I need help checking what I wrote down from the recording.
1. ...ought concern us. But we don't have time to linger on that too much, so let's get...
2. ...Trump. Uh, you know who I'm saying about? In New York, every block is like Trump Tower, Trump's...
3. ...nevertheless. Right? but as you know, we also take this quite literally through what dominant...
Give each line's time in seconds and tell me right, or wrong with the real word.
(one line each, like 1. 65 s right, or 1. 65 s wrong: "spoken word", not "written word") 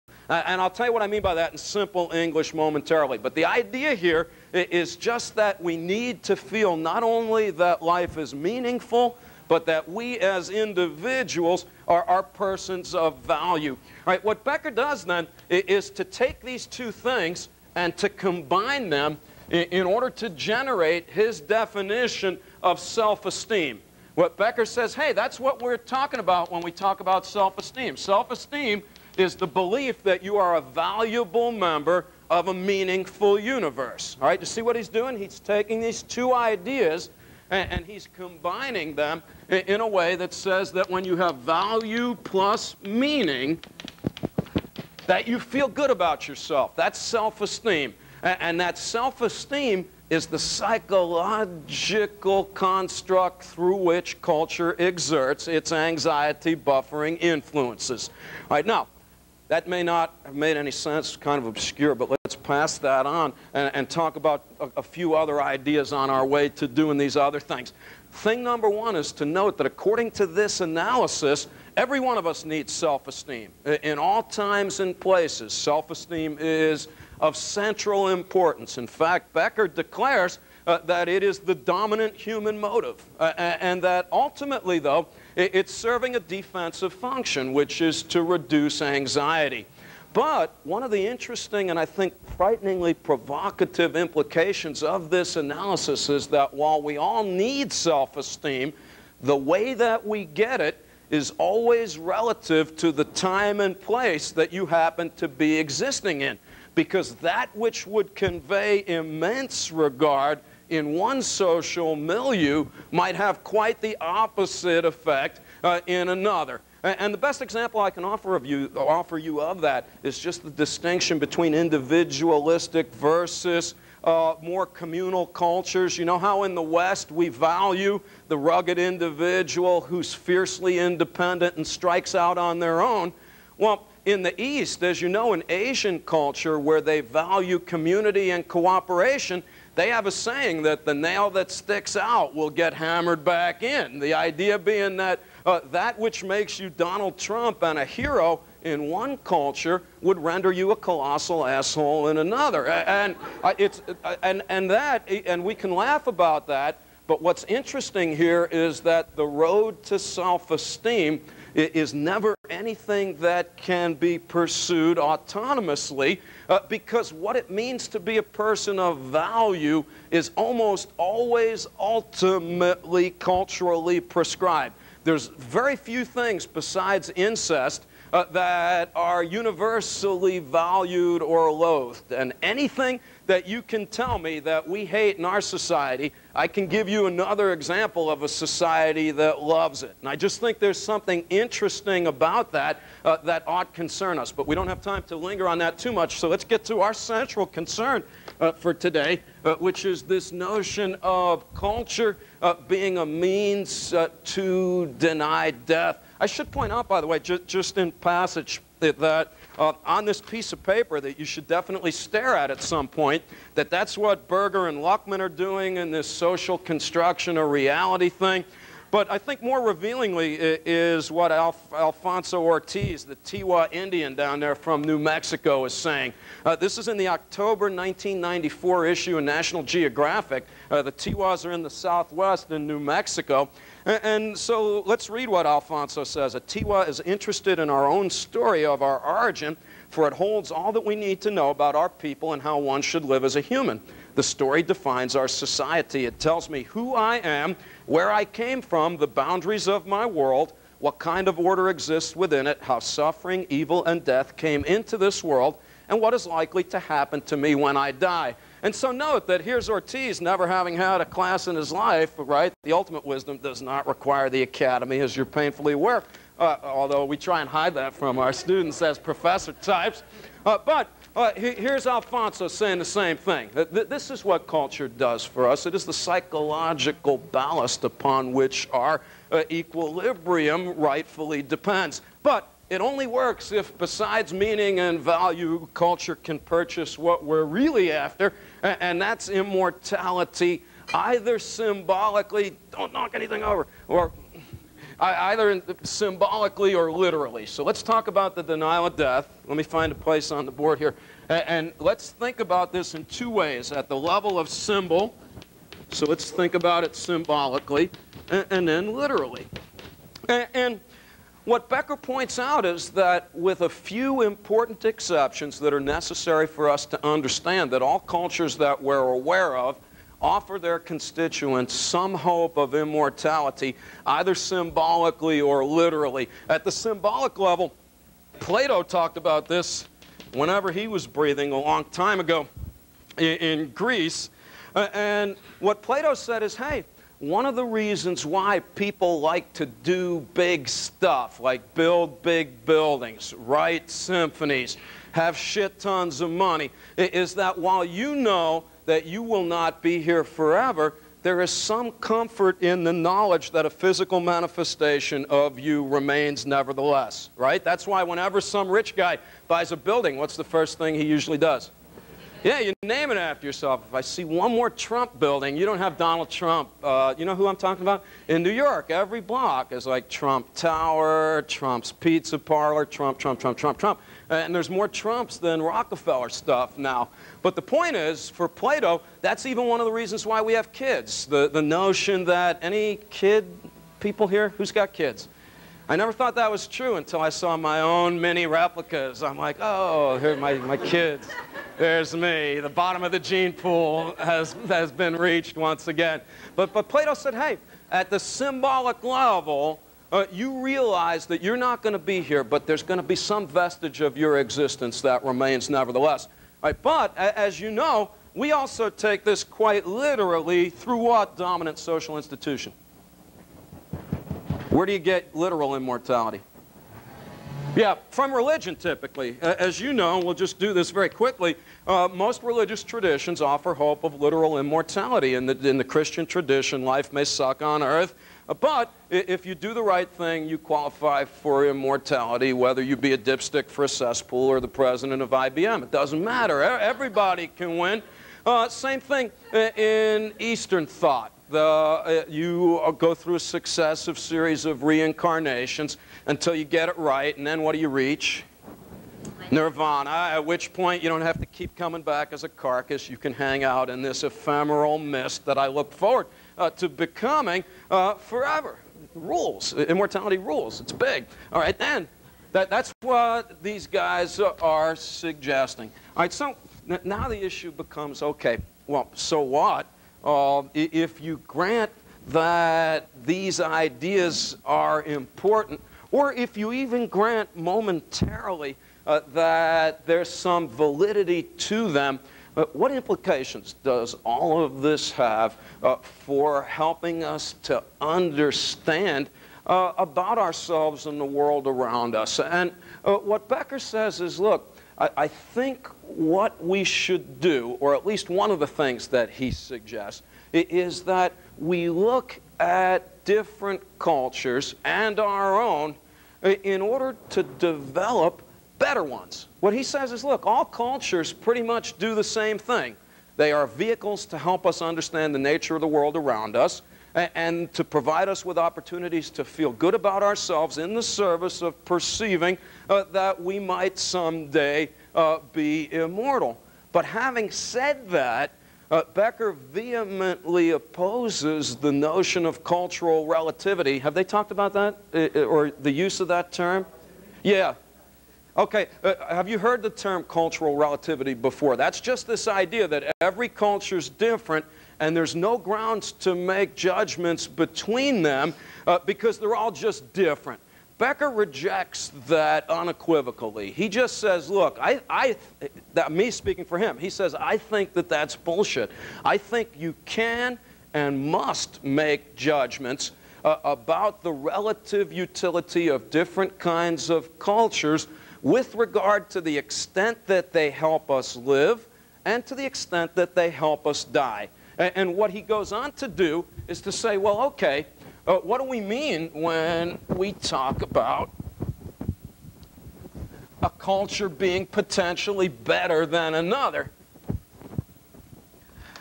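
1. 193 s right
2. 366 s wrong: "talking", not "saying"
3. 405 s right.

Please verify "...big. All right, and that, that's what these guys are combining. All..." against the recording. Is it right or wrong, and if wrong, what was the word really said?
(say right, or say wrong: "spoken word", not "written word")
wrong: "suggesting", not "combining".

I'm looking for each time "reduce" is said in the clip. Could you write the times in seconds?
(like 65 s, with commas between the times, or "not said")
88 s.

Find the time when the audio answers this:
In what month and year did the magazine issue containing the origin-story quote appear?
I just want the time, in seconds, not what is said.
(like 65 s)
227 s.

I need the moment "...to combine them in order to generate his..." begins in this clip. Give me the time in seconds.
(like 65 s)
17 s.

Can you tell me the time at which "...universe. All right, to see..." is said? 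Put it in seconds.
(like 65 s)
33 s.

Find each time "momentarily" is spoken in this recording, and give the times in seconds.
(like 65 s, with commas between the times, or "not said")
2 s, 477 s.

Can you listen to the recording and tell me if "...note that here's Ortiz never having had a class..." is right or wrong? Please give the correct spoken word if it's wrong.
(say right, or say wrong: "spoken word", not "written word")
right.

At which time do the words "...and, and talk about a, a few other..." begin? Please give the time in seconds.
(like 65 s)
63 s.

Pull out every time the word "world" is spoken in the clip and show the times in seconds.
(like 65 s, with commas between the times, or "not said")
250 s, 255 s, 491 s, 515 s.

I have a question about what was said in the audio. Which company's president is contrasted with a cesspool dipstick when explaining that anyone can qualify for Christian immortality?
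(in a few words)
IBM.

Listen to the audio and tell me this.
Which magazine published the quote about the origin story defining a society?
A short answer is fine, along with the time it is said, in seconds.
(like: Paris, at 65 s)
National Geographic, at 229 s.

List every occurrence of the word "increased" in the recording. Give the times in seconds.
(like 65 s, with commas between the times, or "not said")
not said.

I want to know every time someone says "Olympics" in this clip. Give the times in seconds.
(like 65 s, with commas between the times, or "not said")
not said.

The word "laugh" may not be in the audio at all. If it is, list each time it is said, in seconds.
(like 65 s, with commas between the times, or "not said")
155 s.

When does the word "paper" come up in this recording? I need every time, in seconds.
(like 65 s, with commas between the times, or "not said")
210 s.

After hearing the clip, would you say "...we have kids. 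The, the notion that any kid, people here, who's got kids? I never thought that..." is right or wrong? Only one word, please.
right.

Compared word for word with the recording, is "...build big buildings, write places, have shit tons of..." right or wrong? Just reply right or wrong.
wrong.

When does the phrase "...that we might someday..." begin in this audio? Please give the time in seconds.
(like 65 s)
523 s.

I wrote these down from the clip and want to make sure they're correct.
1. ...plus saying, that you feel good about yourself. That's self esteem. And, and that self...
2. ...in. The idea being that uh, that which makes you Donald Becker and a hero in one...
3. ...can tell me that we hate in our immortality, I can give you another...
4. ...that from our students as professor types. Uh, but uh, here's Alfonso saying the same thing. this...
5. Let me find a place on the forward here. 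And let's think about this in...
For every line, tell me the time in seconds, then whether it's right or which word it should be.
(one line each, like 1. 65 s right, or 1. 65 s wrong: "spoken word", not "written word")
1. 42 s wrong: "meaning", not "saying"
2. 143 s wrong: "Trump", not "Becker"
3. 183 s wrong: "society", not "immortality"
4. 267 s right
5. 299 s wrong: "board", not "forward".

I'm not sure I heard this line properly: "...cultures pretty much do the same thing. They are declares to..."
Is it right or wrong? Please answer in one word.
wrong.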